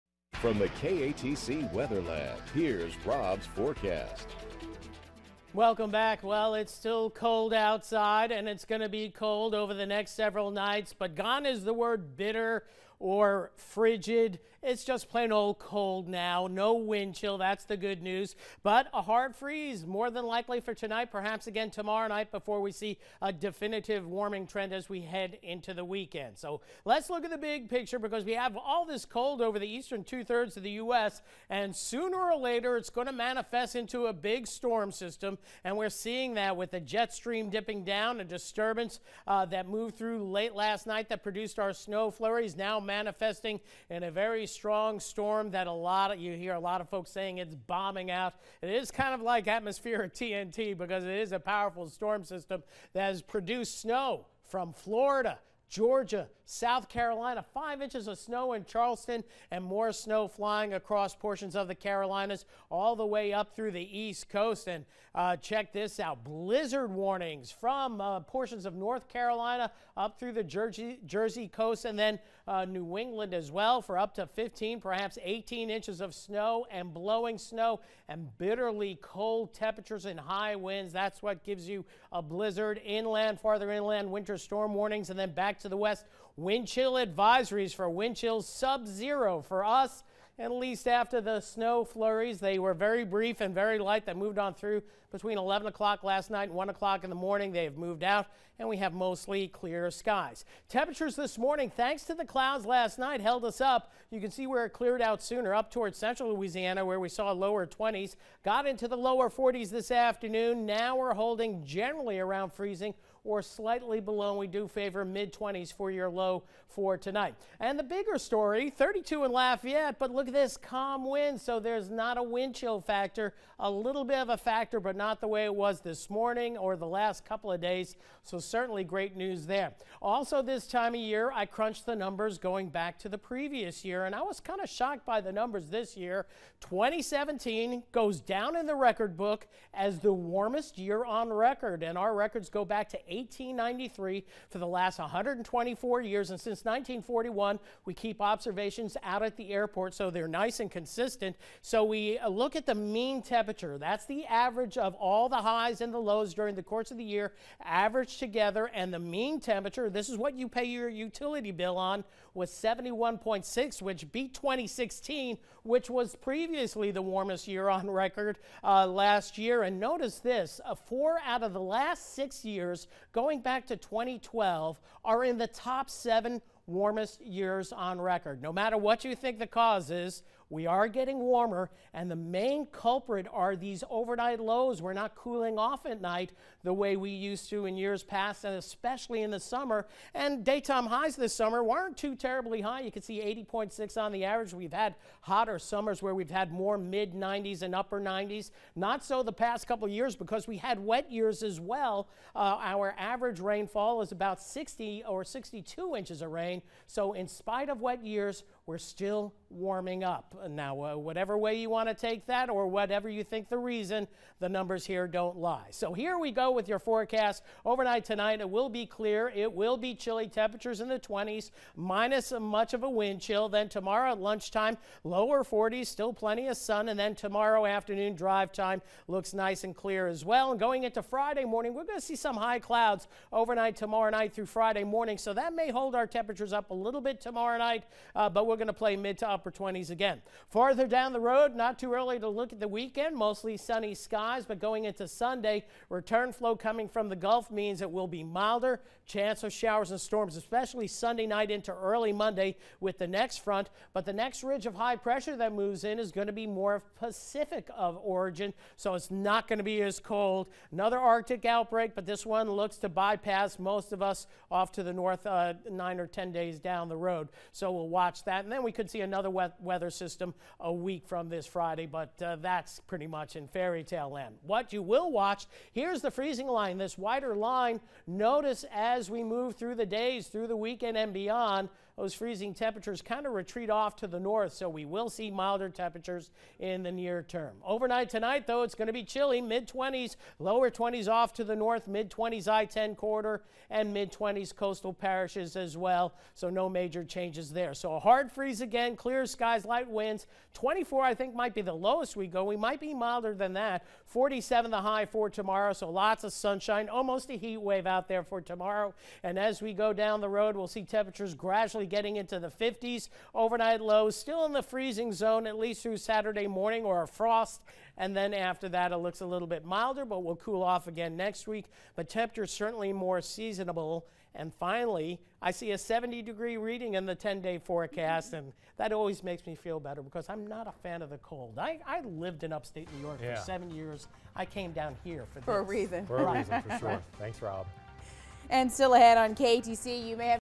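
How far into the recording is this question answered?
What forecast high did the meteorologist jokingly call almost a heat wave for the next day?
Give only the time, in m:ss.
5:04.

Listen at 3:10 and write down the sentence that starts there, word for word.
And daytime highs this summer weren't too terribly high.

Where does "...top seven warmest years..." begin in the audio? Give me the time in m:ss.
2:55.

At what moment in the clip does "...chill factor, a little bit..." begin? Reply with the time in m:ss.
2:02.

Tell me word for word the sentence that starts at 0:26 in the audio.
So let's look at the big picture because we have all this cold over the eastern two thirds of the U.S.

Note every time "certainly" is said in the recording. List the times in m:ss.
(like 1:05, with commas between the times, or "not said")
2:08, 5:22.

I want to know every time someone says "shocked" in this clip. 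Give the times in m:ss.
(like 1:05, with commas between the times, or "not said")
2:14.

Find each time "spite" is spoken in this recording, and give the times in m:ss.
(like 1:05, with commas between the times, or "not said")
3:27.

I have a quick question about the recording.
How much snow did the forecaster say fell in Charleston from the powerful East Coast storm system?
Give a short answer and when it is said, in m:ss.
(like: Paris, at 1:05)
5 inches, at 0:57.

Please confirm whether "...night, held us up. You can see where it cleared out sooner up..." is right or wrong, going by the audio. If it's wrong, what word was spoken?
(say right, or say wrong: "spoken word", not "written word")
right.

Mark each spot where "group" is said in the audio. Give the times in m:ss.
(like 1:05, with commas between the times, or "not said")
not said.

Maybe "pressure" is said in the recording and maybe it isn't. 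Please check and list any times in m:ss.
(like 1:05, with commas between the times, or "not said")
4:14.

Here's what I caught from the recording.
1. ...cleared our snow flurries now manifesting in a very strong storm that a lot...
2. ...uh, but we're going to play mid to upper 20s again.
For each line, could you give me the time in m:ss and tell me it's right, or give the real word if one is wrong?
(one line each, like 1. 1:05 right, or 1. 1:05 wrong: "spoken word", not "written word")
1. 0:41 wrong: "produced", not "cleared"
2. 3:58 right.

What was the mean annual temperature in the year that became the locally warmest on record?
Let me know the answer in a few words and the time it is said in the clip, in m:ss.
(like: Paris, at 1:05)
71.6, at 2:42.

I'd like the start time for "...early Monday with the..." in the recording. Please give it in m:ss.
4:11.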